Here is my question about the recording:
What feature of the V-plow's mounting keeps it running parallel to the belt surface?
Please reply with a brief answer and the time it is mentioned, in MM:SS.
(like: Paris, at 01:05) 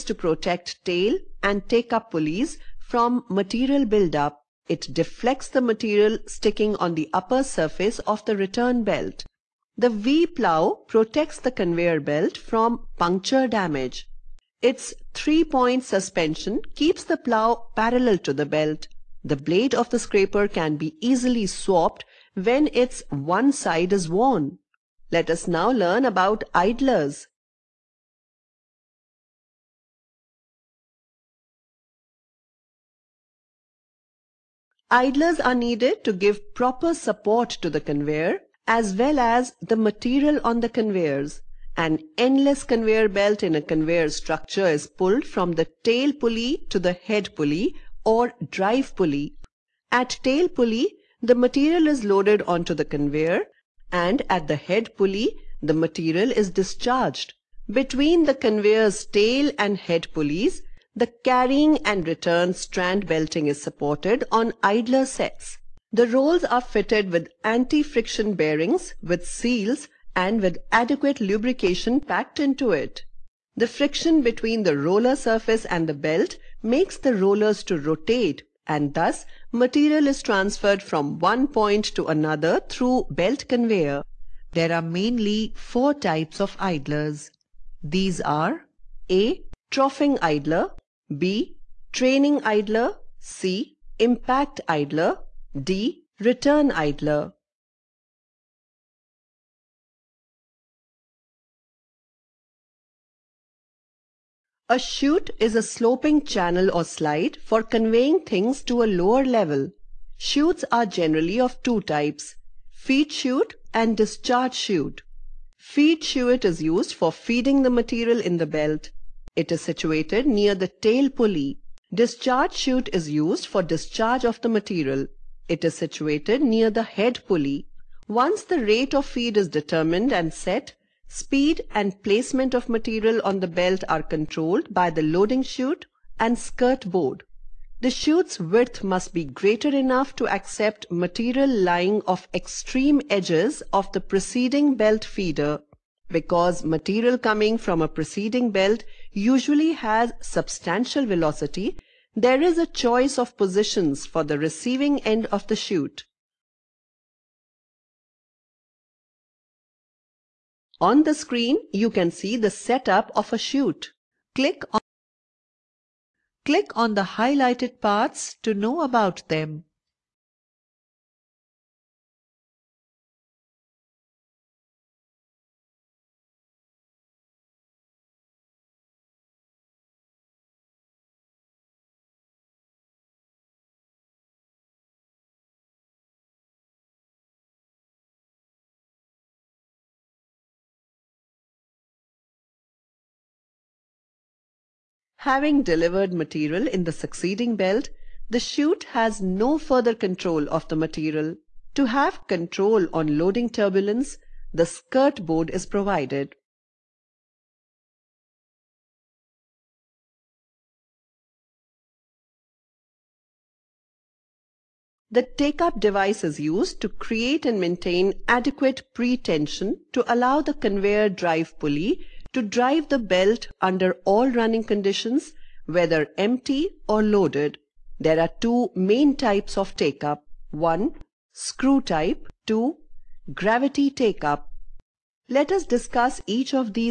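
three-point suspension, at 00:15.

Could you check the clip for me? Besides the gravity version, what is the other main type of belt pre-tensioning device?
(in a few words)
screw type.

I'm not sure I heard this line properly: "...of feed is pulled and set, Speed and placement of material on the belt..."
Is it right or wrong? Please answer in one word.
wrong.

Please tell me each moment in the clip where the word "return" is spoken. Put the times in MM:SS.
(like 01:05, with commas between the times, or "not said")
00:08, 01:02, 01:36.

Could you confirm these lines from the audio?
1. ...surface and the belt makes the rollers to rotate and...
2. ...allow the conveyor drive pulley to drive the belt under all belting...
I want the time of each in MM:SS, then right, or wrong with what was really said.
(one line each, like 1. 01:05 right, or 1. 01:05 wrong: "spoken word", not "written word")
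1. 01:15 right
2. 03:40 wrong: "running", not "belting".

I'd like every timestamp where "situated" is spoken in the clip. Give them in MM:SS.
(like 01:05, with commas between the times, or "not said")
01:59, 02:05.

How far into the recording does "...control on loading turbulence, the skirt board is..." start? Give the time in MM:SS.
03:22.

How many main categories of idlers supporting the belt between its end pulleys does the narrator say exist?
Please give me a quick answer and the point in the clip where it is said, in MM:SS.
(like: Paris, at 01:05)
4, at 01:25.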